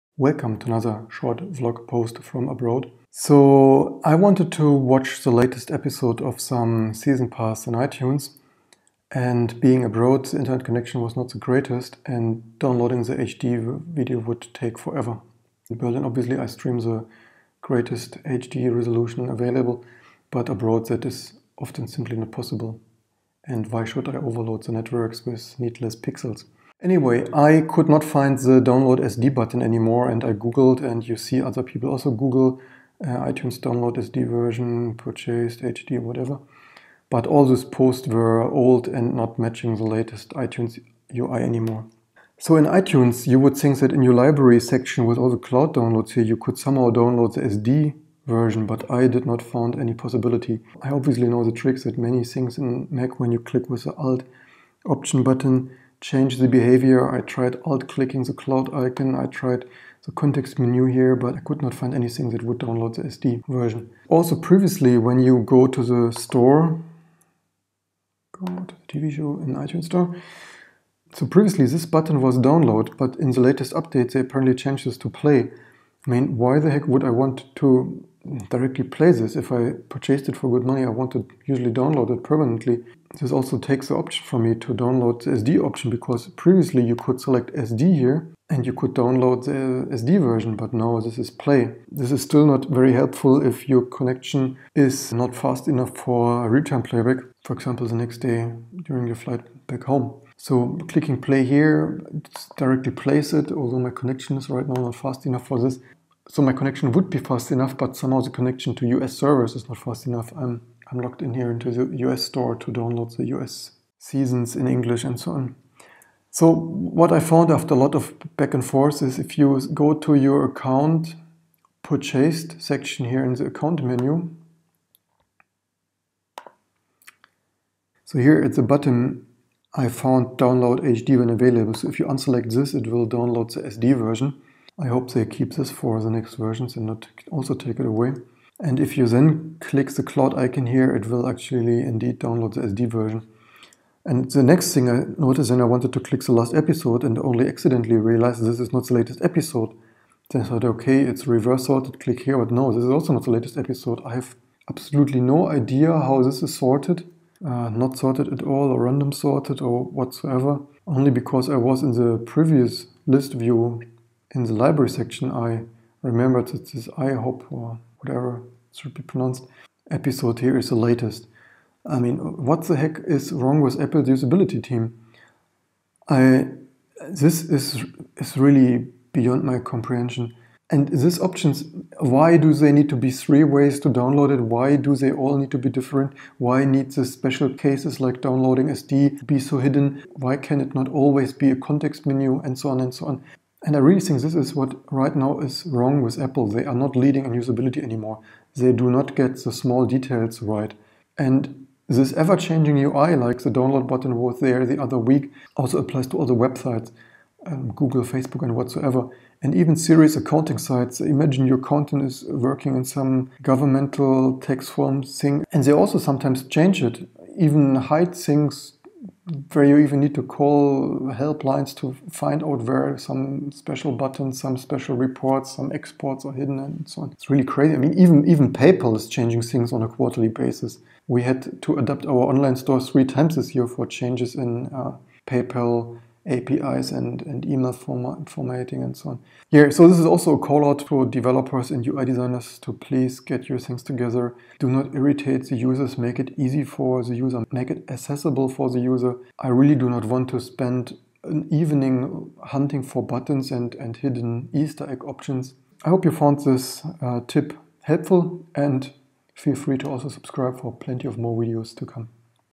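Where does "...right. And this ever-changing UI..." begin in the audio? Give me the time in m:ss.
3:20.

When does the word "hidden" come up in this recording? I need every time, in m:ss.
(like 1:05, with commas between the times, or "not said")
3:09, 3:46, 4:13.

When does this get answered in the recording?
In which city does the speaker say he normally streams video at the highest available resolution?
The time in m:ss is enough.
0:15.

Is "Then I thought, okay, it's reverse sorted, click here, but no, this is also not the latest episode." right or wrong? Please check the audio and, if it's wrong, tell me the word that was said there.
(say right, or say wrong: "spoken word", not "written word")
right.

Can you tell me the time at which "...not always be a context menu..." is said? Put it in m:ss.
3:10.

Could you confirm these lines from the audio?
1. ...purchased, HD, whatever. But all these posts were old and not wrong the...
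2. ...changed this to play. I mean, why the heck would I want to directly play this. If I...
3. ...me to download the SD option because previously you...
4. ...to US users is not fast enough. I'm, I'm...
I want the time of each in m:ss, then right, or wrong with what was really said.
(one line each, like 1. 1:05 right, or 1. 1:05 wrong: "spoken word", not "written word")
1. 0:34 wrong: "matching", not "wrong"
2. 1:14 right
3. 1:24 right
4. 1:48 wrong: "servers", not "users".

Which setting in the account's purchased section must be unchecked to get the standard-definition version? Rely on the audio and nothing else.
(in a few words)
Download HD when available.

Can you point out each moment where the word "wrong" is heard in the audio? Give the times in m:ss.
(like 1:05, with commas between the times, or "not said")
2:53, 3:15.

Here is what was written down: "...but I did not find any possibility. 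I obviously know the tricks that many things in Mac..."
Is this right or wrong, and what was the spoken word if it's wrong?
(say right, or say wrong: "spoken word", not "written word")
right.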